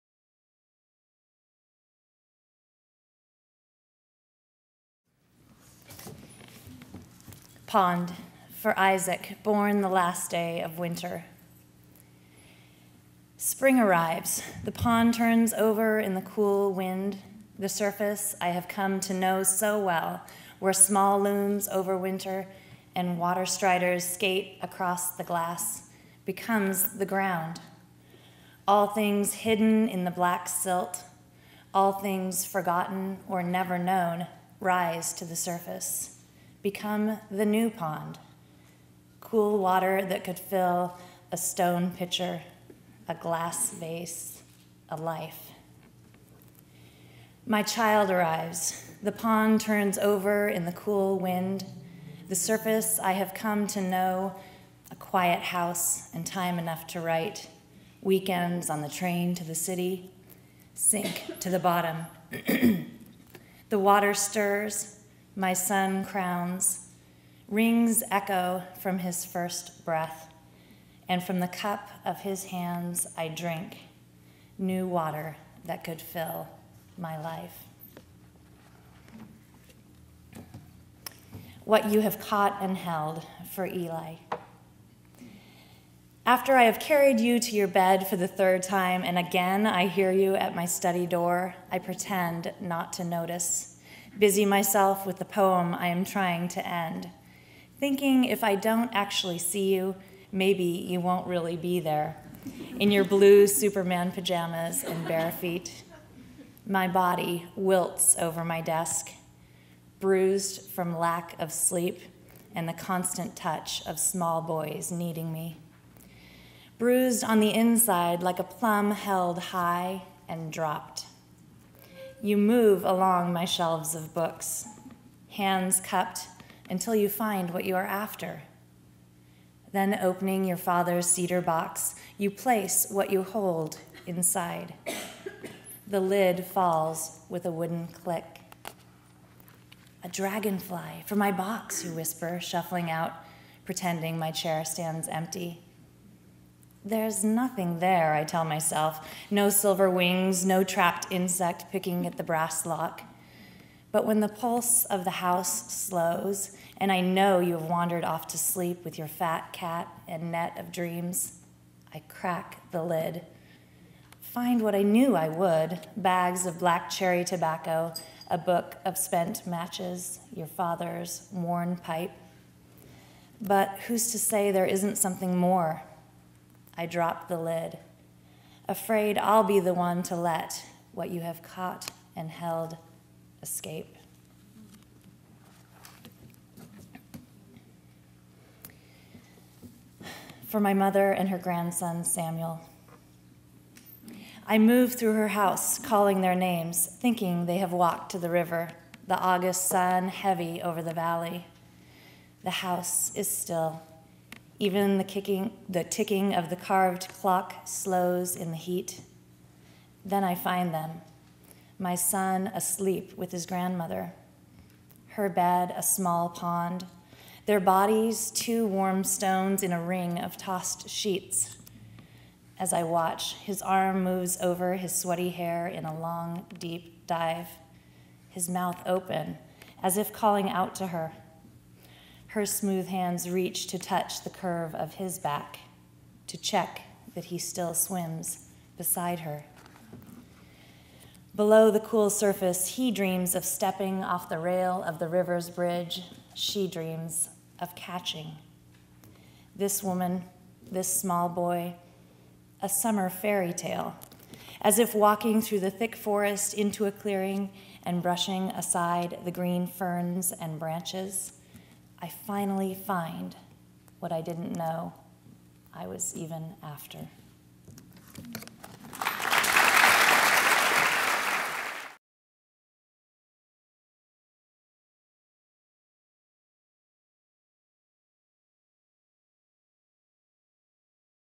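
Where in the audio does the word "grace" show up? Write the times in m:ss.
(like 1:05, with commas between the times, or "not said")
not said.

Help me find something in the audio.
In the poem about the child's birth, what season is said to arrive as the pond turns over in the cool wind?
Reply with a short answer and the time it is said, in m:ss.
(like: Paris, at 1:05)
Spring, at 0:13.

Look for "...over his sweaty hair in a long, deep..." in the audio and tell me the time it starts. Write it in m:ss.
3:44.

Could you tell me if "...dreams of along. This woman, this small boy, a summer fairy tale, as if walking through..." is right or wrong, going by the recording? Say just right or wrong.
wrong.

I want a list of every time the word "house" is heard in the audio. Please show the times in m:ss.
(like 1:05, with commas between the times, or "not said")
0:55, 2:35, 3:15, 3:22.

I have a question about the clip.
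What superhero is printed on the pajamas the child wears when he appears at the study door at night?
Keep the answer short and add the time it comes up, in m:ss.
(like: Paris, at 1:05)
Superman, at 1:43.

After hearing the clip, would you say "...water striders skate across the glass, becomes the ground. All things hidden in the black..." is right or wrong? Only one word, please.
right.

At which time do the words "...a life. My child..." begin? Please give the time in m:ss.
0:44.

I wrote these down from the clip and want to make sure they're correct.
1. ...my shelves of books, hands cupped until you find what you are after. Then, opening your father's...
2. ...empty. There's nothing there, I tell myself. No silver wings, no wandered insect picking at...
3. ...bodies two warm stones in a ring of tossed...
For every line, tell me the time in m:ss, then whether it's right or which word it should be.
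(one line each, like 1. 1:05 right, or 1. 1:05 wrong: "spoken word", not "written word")
1. 2:03 right
2. 2:25 wrong: "trapped", not "wandered"
3. 3:37 right.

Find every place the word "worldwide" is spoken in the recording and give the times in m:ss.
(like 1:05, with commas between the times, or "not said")
not said.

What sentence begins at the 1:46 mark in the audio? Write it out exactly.
My body wilts over my desk, bruised from lack of sleep and the constant touch of small boys needing me.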